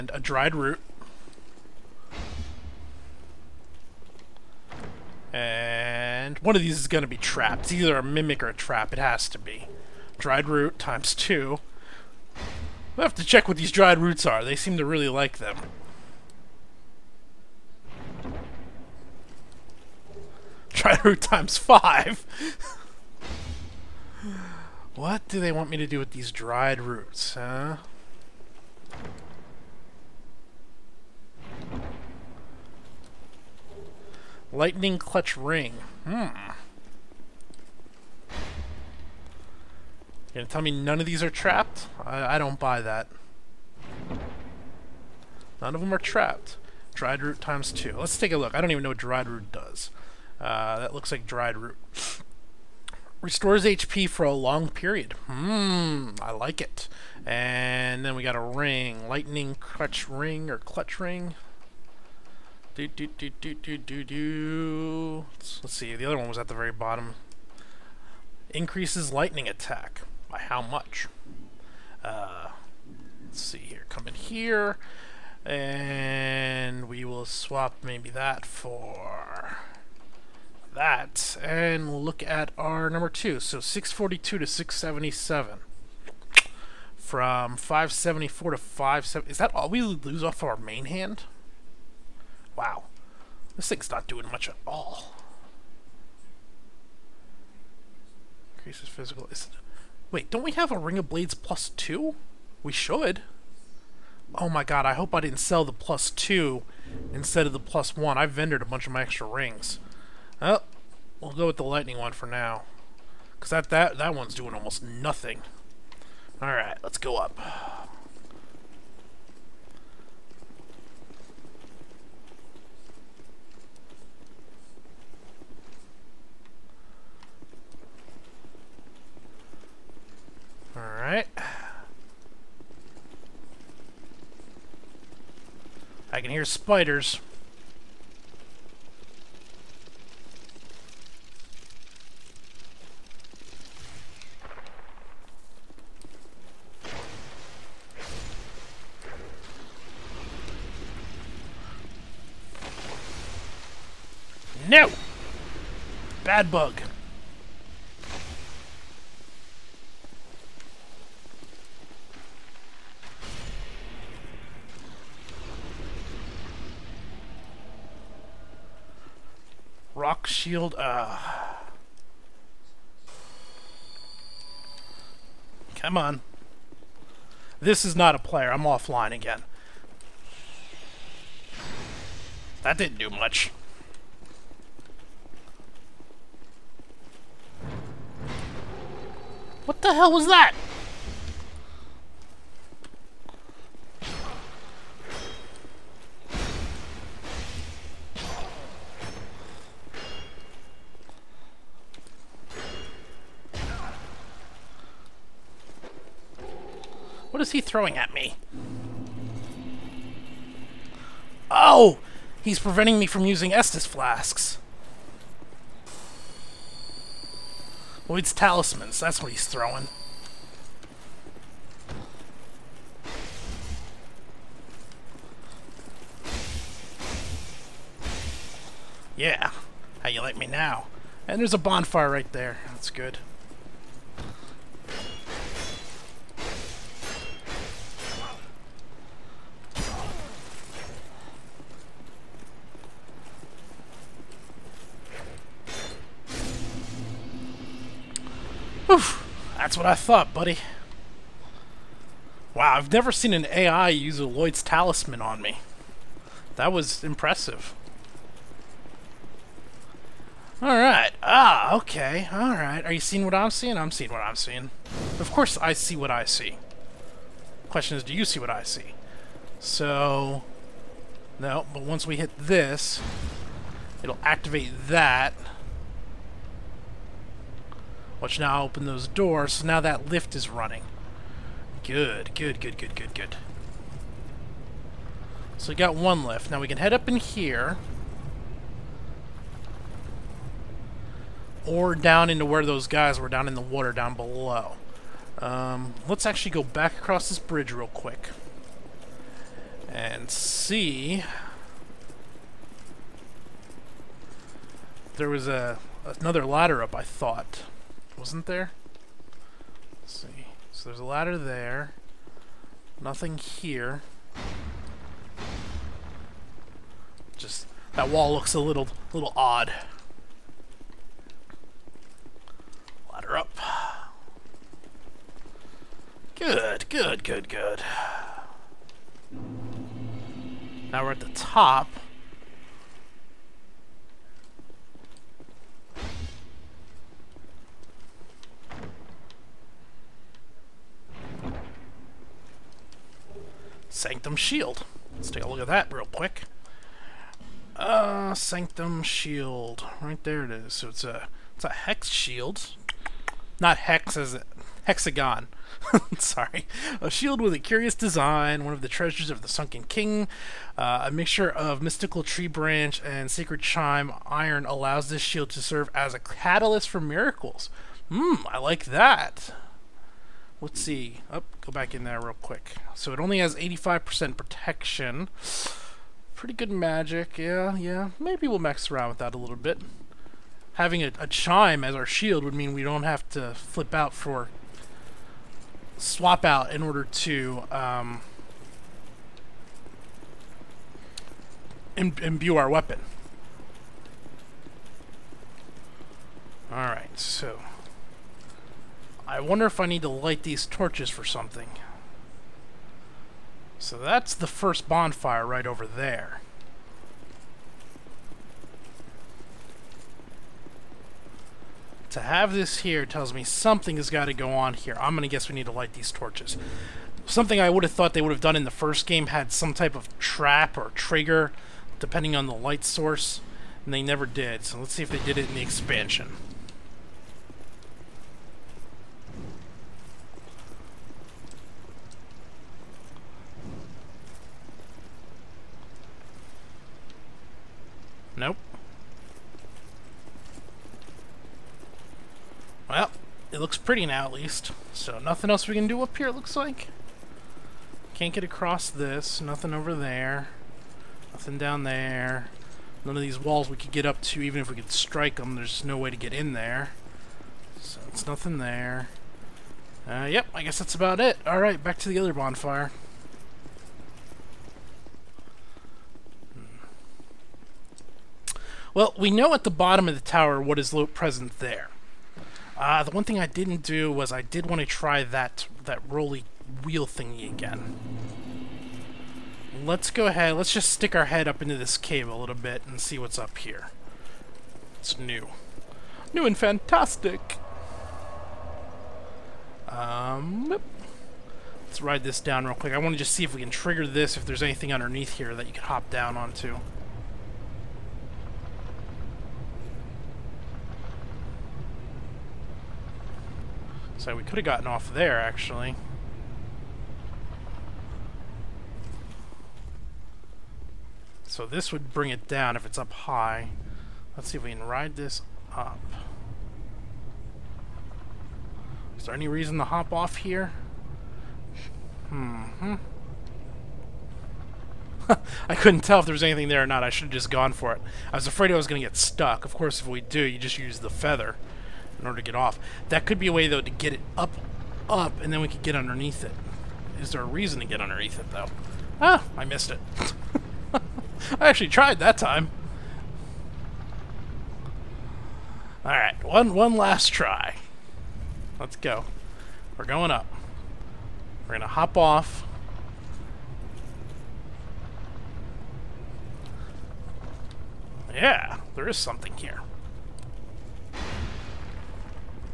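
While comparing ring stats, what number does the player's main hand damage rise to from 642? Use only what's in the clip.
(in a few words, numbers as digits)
677.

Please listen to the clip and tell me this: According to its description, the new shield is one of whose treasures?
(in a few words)
the Sunken King.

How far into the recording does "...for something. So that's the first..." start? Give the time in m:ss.
6:41.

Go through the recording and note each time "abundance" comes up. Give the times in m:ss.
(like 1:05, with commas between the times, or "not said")
not said.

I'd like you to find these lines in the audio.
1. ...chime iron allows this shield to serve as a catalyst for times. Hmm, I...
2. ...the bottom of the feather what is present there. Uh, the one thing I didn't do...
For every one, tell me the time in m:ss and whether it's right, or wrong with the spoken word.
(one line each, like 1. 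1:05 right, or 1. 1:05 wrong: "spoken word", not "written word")
1. 6:03 wrong: "miracles", not "times"
2. 7:49 wrong: "tower", not "feather".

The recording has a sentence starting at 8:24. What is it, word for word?
So we could have gotten off there, actually.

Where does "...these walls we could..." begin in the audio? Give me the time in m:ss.
7:33.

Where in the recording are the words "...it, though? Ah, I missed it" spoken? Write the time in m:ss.
8:58.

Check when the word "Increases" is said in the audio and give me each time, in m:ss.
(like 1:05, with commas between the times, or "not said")
1:08, 1:38.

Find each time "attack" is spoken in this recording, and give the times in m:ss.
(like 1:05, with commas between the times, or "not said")
1:09.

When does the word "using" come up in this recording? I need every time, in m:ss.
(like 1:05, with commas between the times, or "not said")
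3:33.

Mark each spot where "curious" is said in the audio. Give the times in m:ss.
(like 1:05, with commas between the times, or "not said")
5:57.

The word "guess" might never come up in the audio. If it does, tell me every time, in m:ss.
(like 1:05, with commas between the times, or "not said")
6:55, 7:40.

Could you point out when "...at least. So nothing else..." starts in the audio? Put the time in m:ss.
7:24.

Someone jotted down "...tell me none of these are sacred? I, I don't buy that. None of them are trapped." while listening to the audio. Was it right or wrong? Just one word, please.
wrong.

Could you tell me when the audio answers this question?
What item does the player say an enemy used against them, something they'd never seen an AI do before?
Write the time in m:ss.
4:14.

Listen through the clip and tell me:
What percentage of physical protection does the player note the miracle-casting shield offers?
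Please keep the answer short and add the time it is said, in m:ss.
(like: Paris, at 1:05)
85%, at 6:13.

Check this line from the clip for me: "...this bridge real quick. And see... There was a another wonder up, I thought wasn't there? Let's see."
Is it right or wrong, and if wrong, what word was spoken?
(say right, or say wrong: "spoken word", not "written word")
wrong: "ladder", not "wonder".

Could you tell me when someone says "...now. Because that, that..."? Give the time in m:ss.
1:52.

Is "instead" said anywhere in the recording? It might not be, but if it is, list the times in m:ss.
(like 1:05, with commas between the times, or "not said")
1:47.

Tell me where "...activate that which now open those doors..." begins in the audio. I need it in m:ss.
4:34.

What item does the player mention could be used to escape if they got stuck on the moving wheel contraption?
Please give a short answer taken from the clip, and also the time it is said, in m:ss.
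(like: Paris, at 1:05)
the feather, at 8:51.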